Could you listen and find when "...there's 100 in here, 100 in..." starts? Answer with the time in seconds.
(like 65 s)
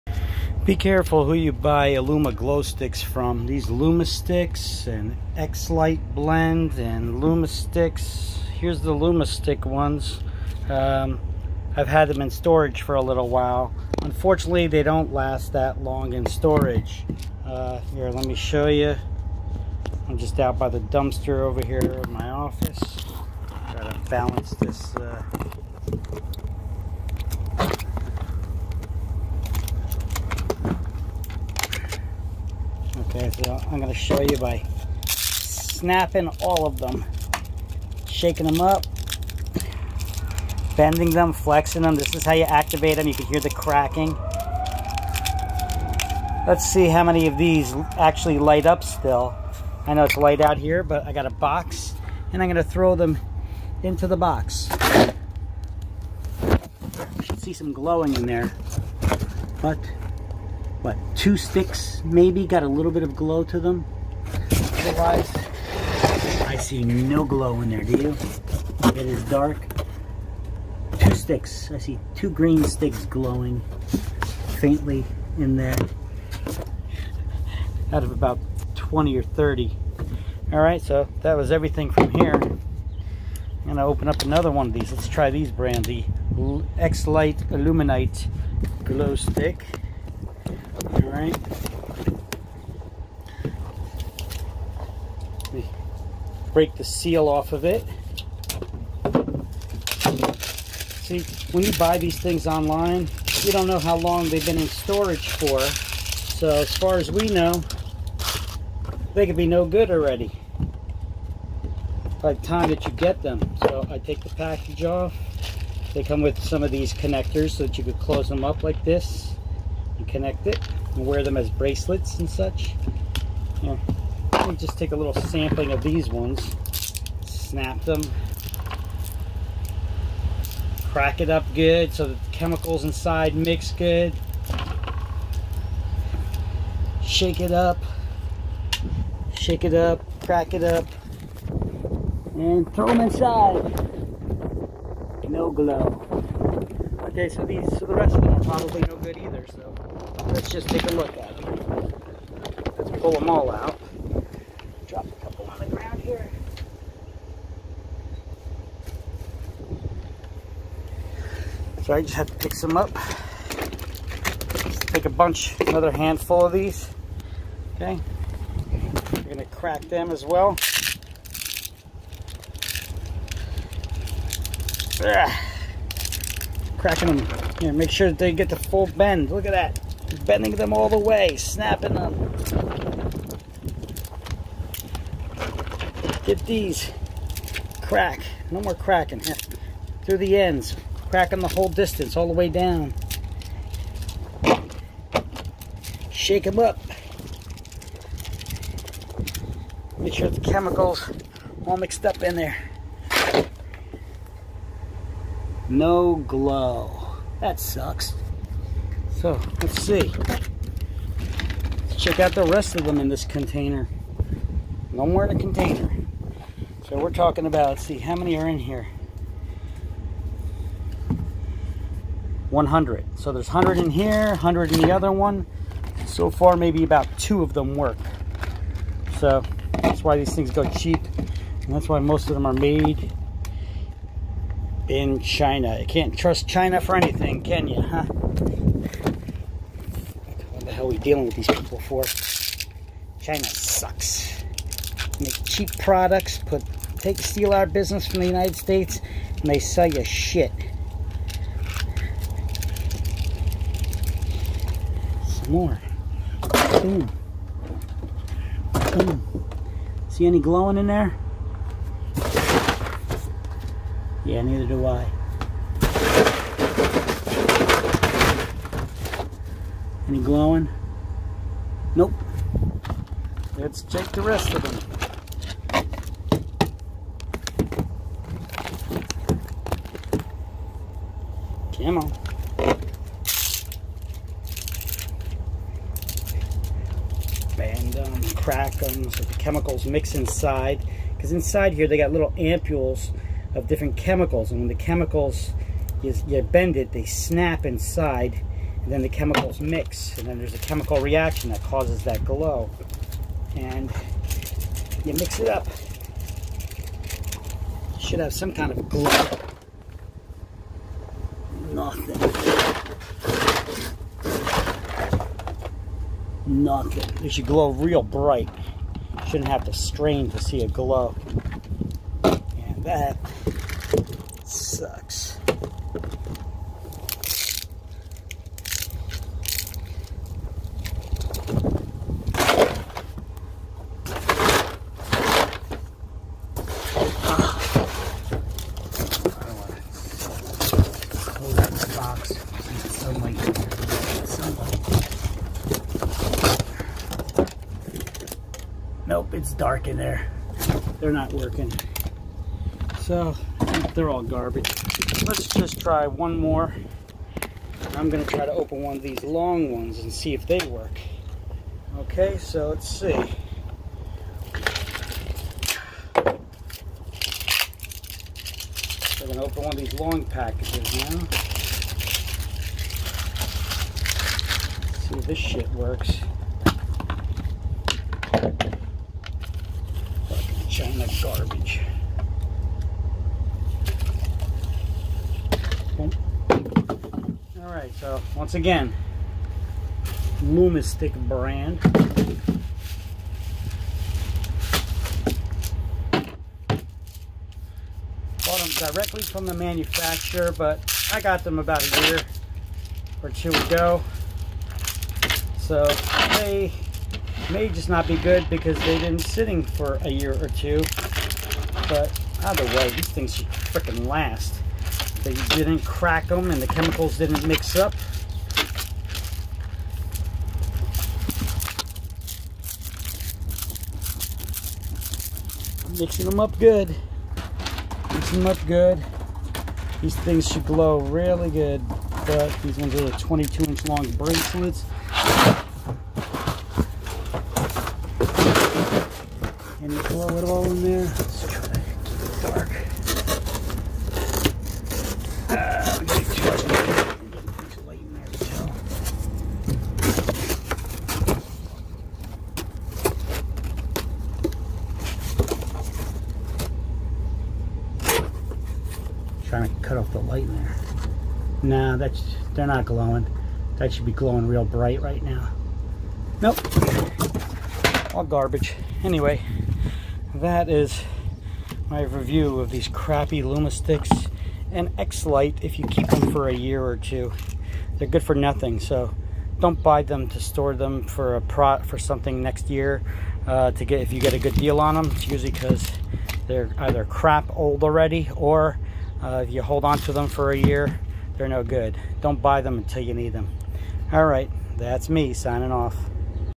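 223 s.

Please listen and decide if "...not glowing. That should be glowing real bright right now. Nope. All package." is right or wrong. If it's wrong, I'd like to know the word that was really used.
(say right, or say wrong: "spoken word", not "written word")
wrong: "garbage", not "package".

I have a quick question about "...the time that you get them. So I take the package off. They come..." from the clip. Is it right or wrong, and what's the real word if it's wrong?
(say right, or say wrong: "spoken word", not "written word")
right.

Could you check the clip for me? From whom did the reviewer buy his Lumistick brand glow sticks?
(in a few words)
the manufacturer.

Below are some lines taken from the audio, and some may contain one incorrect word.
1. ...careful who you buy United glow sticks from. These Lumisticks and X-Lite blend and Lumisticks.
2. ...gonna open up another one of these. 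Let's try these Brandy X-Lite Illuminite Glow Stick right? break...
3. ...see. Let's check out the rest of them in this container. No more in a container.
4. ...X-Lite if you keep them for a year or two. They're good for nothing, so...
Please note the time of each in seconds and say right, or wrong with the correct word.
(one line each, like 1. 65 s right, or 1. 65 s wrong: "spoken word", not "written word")
1. 0 s wrong: "Illuma", not "United"
2. 83 s right
3. 209 s right
4. 474 s right.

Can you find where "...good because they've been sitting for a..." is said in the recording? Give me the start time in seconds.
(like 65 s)
408 s.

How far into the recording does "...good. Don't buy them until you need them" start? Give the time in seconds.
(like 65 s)
491 s.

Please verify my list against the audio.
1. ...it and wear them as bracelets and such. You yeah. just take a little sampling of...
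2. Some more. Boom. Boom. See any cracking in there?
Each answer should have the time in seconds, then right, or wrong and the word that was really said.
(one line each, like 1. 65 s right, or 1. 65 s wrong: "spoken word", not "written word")
1. 120 s right
2. 255 s wrong: "glowing", not "cracking".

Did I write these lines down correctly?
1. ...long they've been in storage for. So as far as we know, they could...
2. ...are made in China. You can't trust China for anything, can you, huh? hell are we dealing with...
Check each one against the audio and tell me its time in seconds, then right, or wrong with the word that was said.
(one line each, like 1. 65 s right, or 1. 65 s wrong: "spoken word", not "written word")
1. 103 s right
2. 232 s right.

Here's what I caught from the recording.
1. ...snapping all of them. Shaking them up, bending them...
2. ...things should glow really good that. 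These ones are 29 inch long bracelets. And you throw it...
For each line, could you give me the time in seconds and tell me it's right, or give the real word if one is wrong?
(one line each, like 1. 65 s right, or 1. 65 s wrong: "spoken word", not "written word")
1. 35 s right
2. 430 s wrong: "22", not "29".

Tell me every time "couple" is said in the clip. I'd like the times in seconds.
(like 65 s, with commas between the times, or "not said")
155 s.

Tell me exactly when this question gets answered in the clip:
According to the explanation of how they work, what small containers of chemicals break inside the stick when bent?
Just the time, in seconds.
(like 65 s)
292 s.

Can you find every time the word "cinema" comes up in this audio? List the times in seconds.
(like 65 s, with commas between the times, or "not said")
not said.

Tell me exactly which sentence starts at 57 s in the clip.
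Should see some glowing in there, but what, two sticks maybe, got a little bit of glow to them.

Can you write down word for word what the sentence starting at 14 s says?
Unfortunately, they don't last that long in storage.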